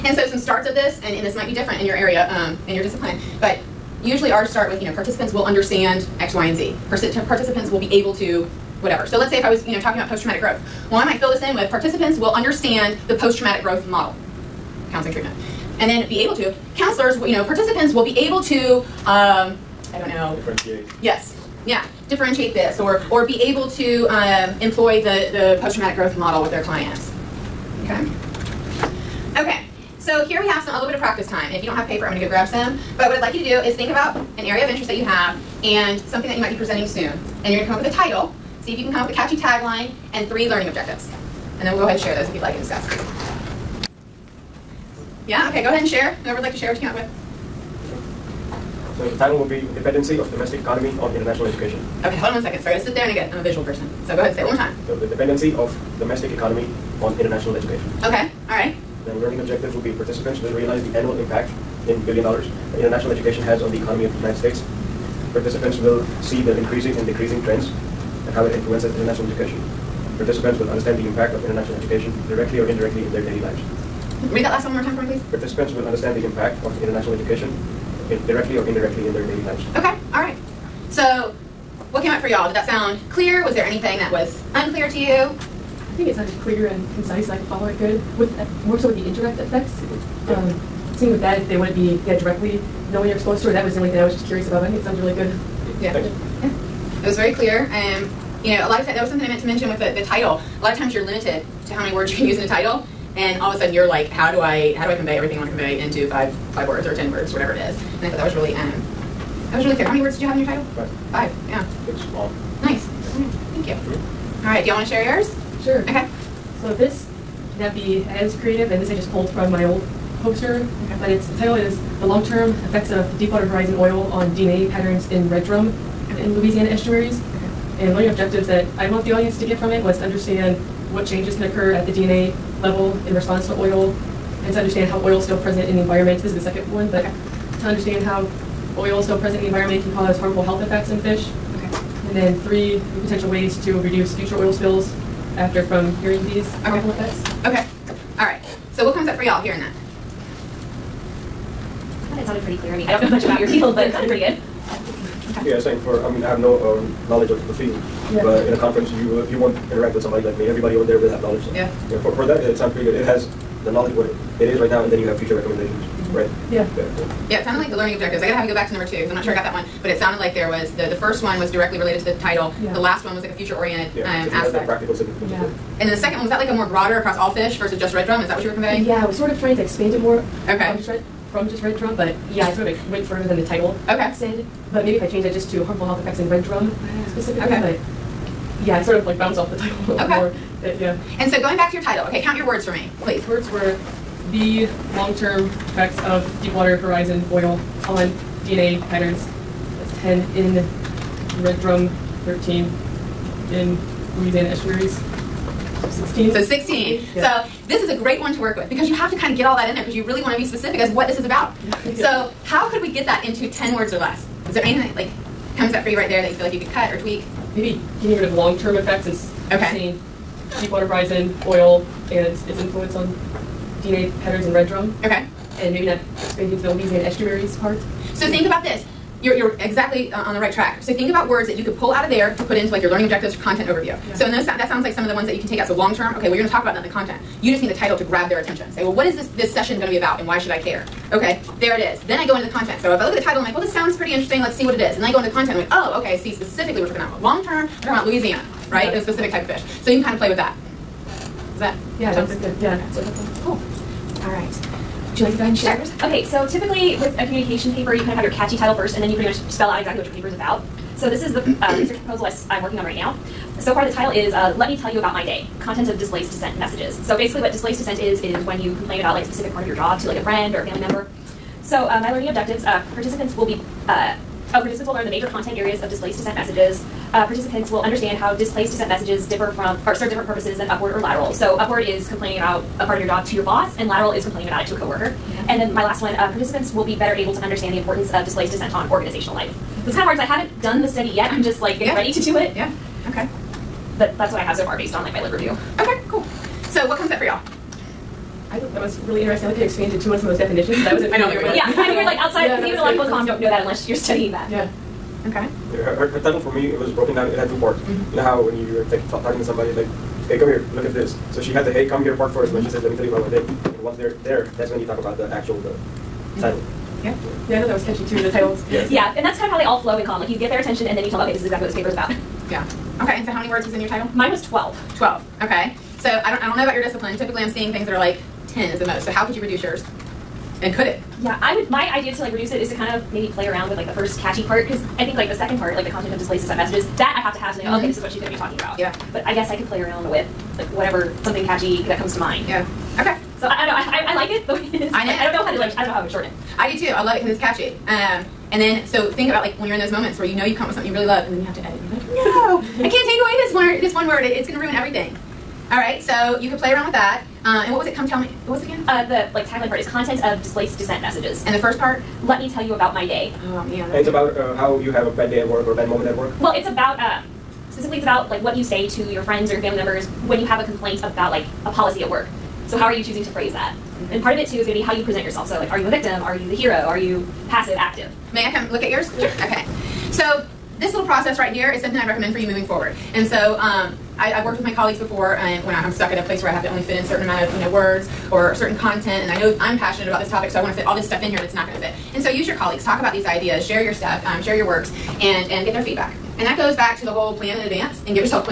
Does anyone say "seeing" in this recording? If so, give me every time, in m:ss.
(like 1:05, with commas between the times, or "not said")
1:30, 5:27.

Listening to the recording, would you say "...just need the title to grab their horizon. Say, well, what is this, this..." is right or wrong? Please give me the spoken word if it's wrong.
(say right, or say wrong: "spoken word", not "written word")
wrong: "attention", not "horizon".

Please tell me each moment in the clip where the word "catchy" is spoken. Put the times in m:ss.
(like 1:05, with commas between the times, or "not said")
0:39, 4:18, 5:17, 5:34, 5:41, 5:47.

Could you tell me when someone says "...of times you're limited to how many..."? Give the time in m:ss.
1:40.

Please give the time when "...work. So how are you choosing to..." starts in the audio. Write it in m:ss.
6:12.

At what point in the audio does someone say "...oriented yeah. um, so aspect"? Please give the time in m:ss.
2:53.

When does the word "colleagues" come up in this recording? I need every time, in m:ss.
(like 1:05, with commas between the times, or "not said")
6:24, 6:32.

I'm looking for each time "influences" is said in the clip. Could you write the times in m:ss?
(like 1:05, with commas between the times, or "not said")
1:08, 3:42.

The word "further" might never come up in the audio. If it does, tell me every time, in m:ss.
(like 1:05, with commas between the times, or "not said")
3:03.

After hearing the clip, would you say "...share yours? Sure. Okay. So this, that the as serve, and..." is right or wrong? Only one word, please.
wrong.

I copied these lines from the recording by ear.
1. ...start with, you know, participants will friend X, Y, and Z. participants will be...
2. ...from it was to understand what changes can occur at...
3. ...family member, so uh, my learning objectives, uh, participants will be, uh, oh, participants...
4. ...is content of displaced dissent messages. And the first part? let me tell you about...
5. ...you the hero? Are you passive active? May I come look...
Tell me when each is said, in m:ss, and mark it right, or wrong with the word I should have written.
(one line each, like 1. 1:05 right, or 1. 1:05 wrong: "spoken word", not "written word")
1. 0:04 wrong: "understand", not "friend"
2. 2:09 right
3. 4:30 right
4. 5:59 right
5. 6:16 right.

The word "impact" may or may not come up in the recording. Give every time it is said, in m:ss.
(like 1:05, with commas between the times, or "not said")
1:01, 1:11, 1:16.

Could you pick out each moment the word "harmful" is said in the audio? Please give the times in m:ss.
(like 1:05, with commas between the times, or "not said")
2:20, 2:26, 3:05.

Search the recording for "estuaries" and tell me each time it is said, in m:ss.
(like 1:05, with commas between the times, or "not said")
2:06, 3:24, 3:47.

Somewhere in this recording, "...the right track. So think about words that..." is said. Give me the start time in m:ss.
3:50.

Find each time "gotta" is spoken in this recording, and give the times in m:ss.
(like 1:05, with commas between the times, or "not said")
0:52, 2:48.